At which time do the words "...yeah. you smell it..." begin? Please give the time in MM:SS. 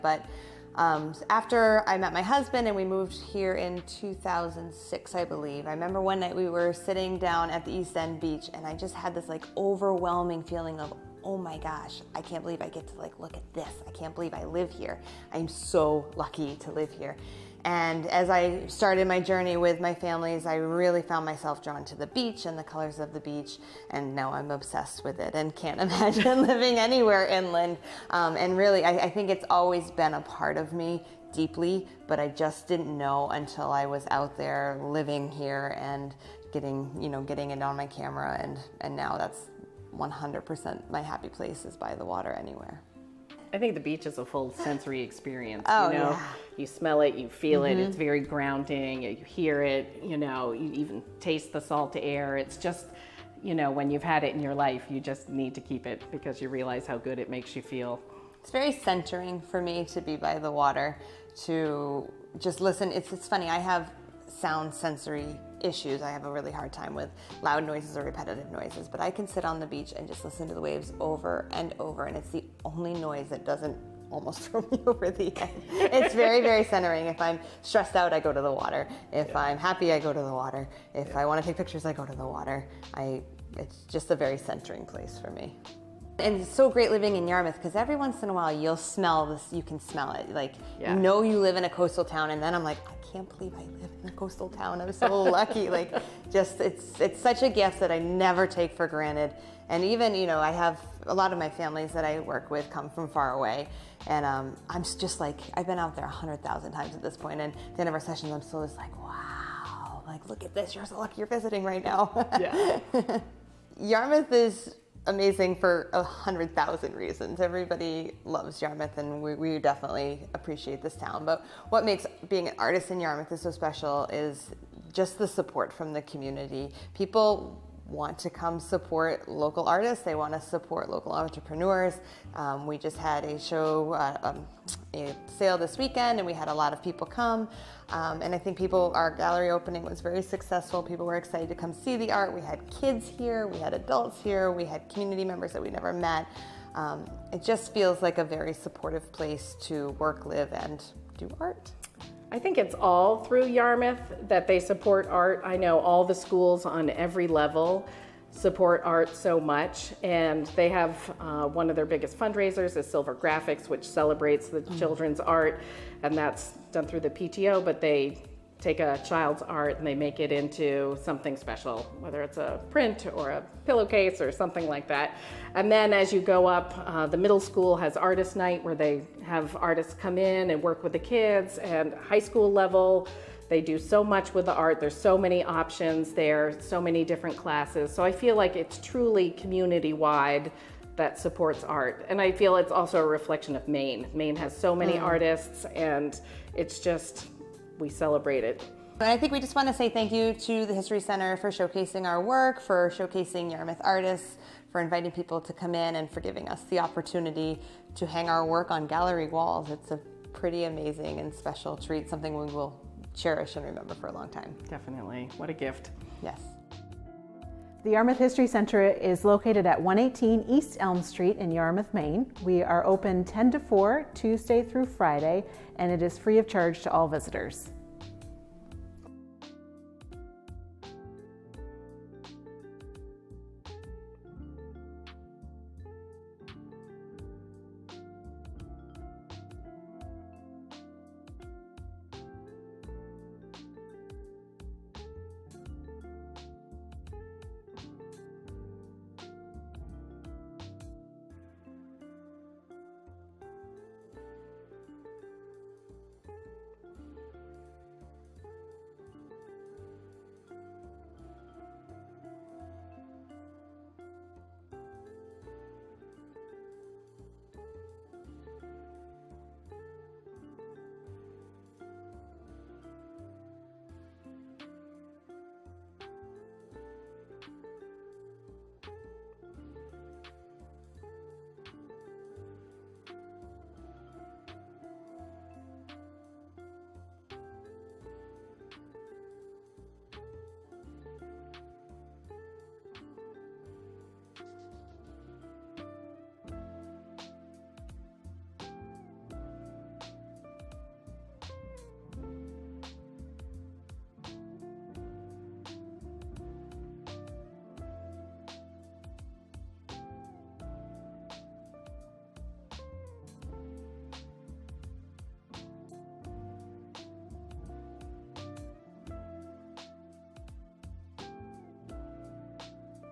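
00:46.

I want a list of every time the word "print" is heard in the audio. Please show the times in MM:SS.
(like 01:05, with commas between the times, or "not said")
02:52.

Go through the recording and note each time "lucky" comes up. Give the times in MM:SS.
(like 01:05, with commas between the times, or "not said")
00:16, 01:35, 01:50.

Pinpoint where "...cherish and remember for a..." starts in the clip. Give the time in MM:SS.
03:33.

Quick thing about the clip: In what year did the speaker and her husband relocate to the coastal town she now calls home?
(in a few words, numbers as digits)
2006.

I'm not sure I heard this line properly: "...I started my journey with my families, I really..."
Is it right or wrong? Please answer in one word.
right.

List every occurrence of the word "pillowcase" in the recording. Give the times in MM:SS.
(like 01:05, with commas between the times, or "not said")
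02:53.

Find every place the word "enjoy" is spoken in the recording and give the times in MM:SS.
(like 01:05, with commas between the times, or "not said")
not said.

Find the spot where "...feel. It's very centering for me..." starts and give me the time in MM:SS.
00:57.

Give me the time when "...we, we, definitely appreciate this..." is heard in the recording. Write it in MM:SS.
01:59.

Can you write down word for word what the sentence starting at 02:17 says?
Um, and I think people, our gallery opening was very successful.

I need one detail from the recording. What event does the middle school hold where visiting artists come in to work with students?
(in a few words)
artist night.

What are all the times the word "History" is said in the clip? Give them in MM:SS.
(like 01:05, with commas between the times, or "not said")
03:20, 03:38.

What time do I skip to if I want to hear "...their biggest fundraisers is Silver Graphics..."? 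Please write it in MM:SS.
02:41.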